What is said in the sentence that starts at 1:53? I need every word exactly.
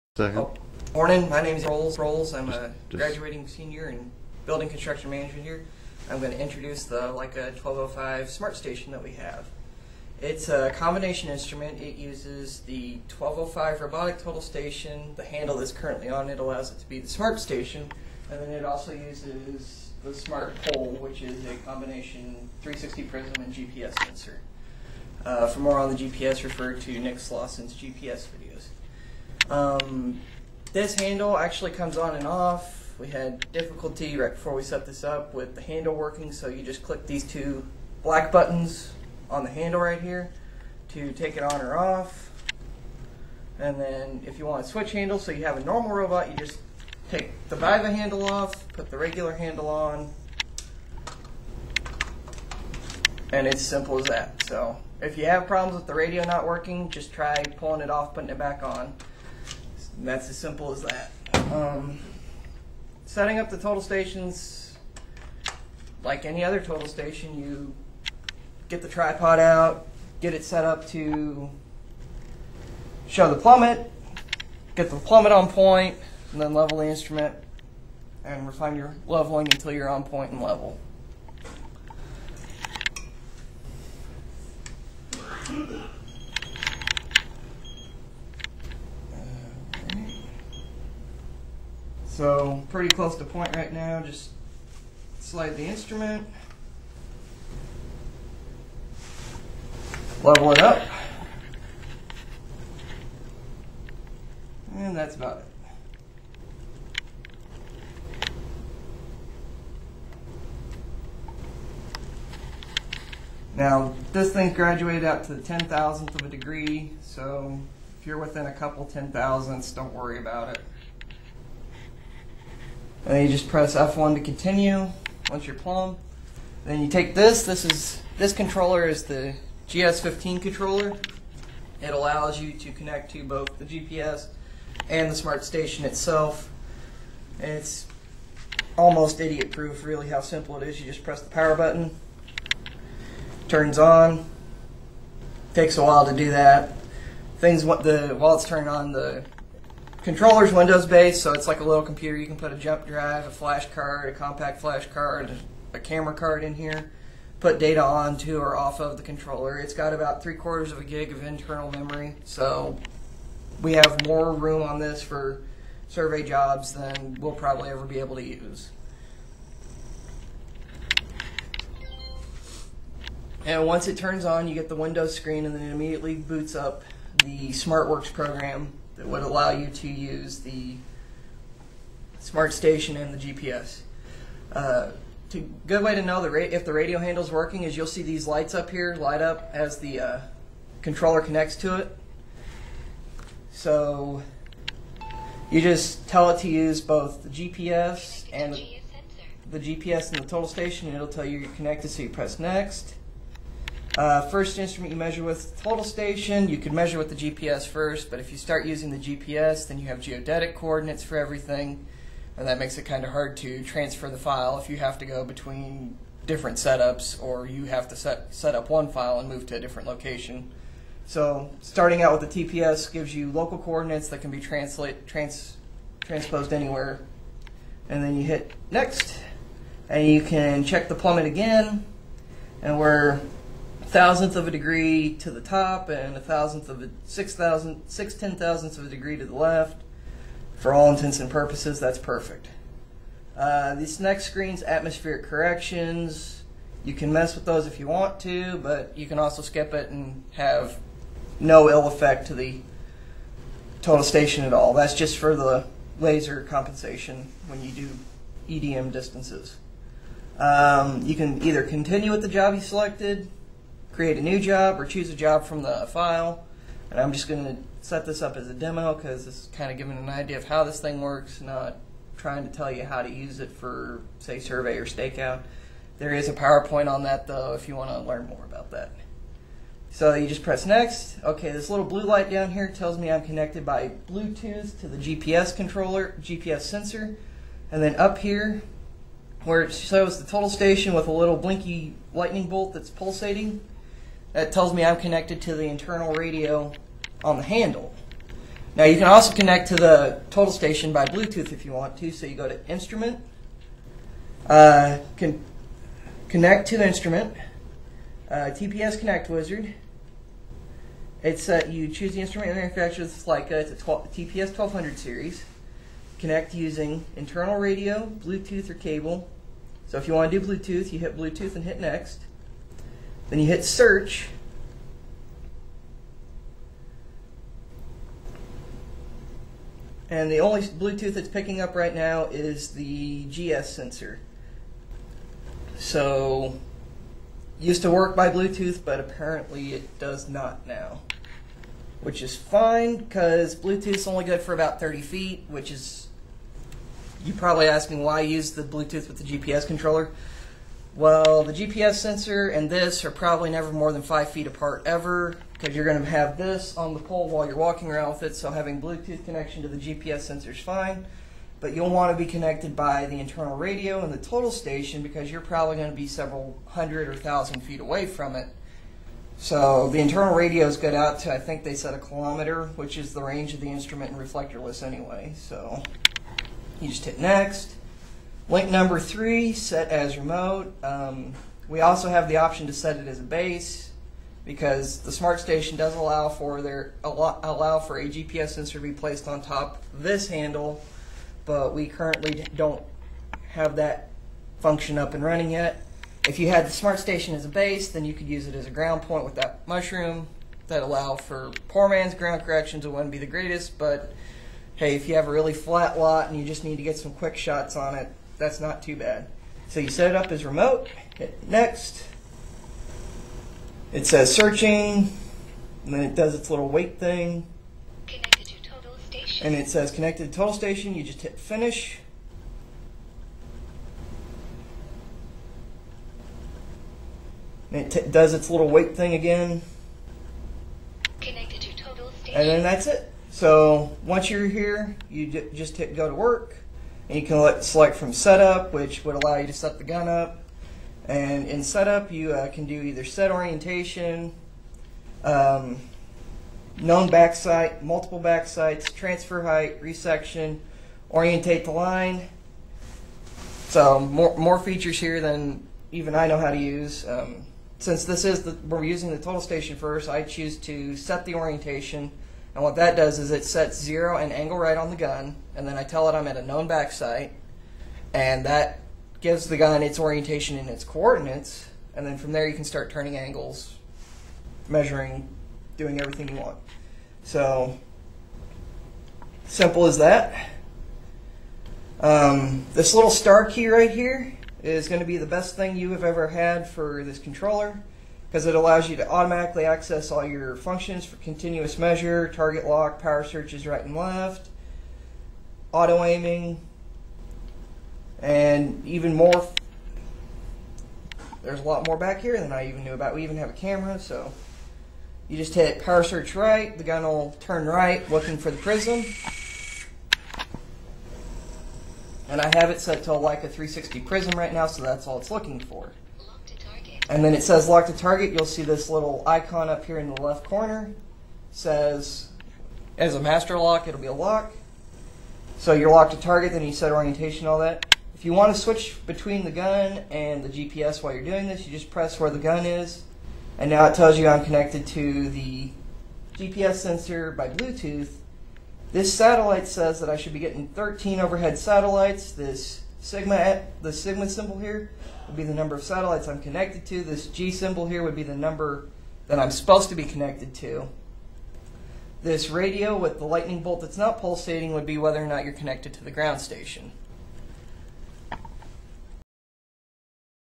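Now, this thing's graduated out to the 10,000th of a degree, so if you're within a couple 10,000ths, don't worry about it.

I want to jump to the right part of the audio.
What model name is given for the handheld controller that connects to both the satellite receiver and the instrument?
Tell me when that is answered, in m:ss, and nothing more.
2:09.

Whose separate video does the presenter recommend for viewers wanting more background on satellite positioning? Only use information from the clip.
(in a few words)
Nick Slausson.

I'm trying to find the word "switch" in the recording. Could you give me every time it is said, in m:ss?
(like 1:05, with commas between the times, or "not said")
0:44, 8:48.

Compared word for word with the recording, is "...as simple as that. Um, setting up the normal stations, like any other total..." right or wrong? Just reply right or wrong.
wrong.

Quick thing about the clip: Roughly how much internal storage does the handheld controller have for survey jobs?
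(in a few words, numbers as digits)
three quarters of a gig.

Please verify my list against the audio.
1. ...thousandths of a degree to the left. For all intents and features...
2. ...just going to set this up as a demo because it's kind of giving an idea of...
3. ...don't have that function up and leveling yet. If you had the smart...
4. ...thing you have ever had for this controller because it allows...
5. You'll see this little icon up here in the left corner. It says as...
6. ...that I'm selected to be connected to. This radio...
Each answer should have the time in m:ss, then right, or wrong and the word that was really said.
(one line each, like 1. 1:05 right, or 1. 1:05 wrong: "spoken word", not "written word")
1. 3:58 wrong: "purposes", not "features"
2. 4:27 right
3. 6:32 wrong: "running", not "leveling"
4. 8:05 right
5. 8:38 right
6. 9:09 wrong: "supposed", not "selected".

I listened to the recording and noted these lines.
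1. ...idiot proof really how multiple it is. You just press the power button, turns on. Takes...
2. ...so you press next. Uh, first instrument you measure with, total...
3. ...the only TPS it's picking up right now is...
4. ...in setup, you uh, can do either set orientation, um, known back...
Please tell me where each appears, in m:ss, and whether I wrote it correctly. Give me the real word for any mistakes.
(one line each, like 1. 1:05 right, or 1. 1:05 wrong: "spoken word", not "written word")
1. 2:19 wrong: "simple", not "multiple"
2. 3:21 right
3. 5:30 wrong: "Bluetooth", not "TPS"
4. 7:21 right.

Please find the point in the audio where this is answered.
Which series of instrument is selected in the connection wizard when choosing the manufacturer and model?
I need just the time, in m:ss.
5:13.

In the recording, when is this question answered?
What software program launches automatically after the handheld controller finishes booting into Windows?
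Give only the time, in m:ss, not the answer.
2:57.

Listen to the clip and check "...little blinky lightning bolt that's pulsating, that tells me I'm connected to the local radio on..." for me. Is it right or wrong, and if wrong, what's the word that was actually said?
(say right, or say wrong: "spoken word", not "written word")
wrong: "internal", not "local".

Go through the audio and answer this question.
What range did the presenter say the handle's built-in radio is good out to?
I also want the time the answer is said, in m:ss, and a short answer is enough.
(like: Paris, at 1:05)
a kilometer, at 6:11.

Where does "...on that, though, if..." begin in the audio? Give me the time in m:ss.
4:36.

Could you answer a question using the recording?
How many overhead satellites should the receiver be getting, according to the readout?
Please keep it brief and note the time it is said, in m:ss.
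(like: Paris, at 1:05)
13, at 9:00.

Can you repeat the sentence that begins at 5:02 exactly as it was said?
So you go to instrument, uh, connect to instrument, uh, TPS connect wizard.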